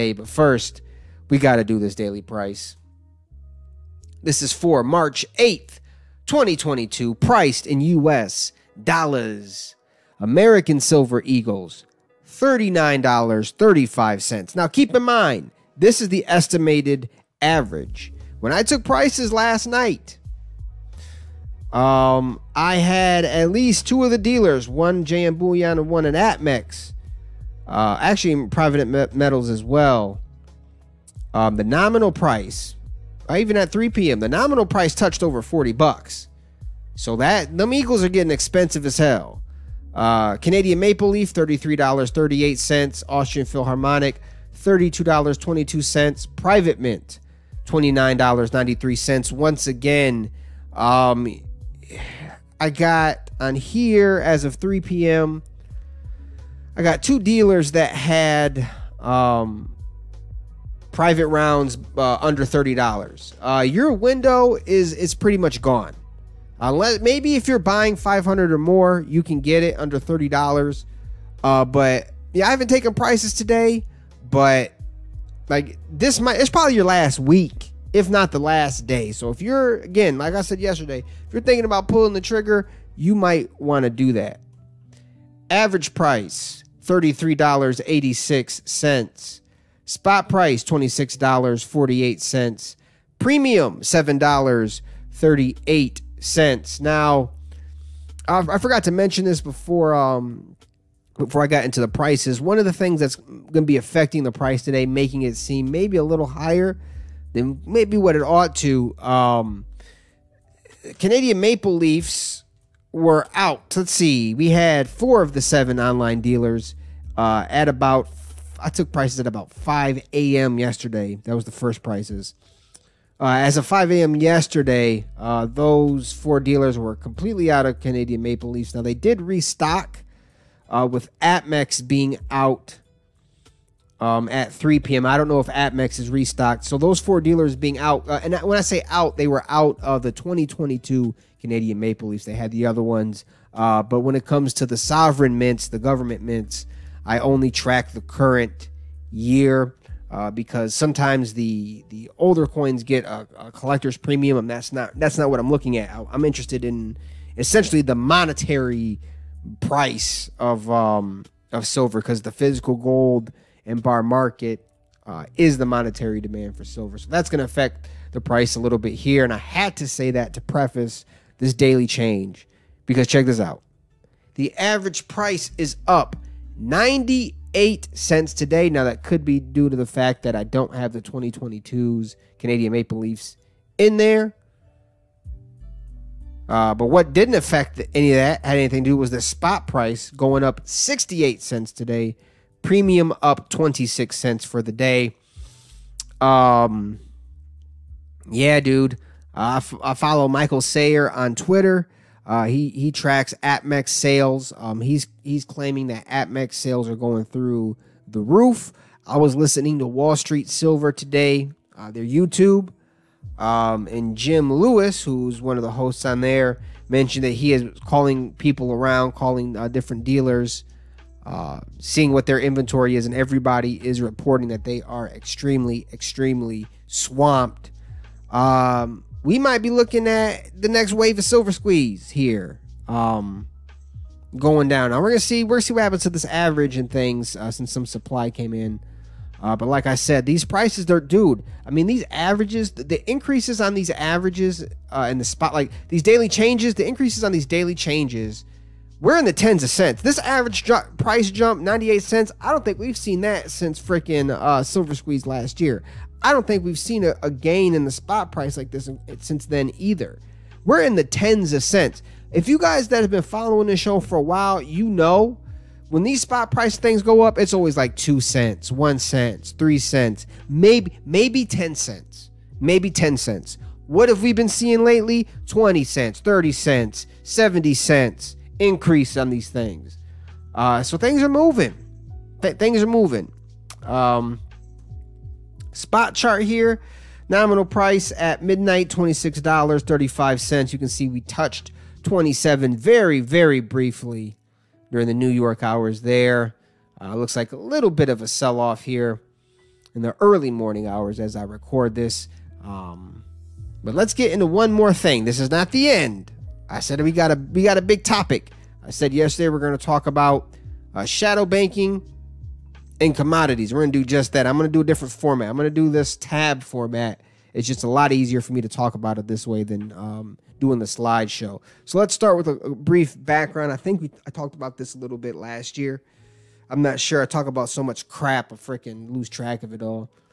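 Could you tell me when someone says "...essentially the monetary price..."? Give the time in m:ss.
2:37.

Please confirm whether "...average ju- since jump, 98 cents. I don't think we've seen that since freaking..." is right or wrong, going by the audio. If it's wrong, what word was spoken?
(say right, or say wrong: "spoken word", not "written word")
wrong: "price", not "since".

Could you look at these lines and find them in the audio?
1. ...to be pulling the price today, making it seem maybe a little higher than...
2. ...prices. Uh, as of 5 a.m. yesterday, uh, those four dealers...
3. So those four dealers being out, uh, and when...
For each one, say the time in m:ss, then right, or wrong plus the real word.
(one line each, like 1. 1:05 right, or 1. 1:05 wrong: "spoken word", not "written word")
1. 1:43 wrong: "affecting", not "pulling"
2. 2:01 right
3. 2:16 right.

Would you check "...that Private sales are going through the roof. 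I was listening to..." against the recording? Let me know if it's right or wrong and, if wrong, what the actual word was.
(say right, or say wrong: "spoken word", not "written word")
wrong: "APMEX", not "Private".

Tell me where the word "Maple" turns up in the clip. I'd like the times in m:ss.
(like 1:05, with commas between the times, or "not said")
0:40, 1:51, 2:08, 2:21, 3:02.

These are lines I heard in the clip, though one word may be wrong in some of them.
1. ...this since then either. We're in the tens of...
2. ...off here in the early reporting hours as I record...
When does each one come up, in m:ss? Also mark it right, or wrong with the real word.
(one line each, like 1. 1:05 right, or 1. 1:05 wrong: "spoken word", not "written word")
1. 4:18 right
2. 4:58 wrong: "morning", not "reporting".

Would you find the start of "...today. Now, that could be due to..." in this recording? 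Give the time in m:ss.
2:58.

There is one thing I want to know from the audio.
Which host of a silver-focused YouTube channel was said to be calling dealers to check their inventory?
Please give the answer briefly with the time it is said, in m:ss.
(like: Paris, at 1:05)
Jim Lewis, at 3:34.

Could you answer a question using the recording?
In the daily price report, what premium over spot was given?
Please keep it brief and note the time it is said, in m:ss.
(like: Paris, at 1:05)
$7.38, at 1:33.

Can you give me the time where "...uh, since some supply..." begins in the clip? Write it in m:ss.
3:57.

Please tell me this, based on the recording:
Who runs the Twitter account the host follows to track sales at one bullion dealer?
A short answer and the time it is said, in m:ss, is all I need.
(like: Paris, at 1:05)
Michael Sayer, at 3:20.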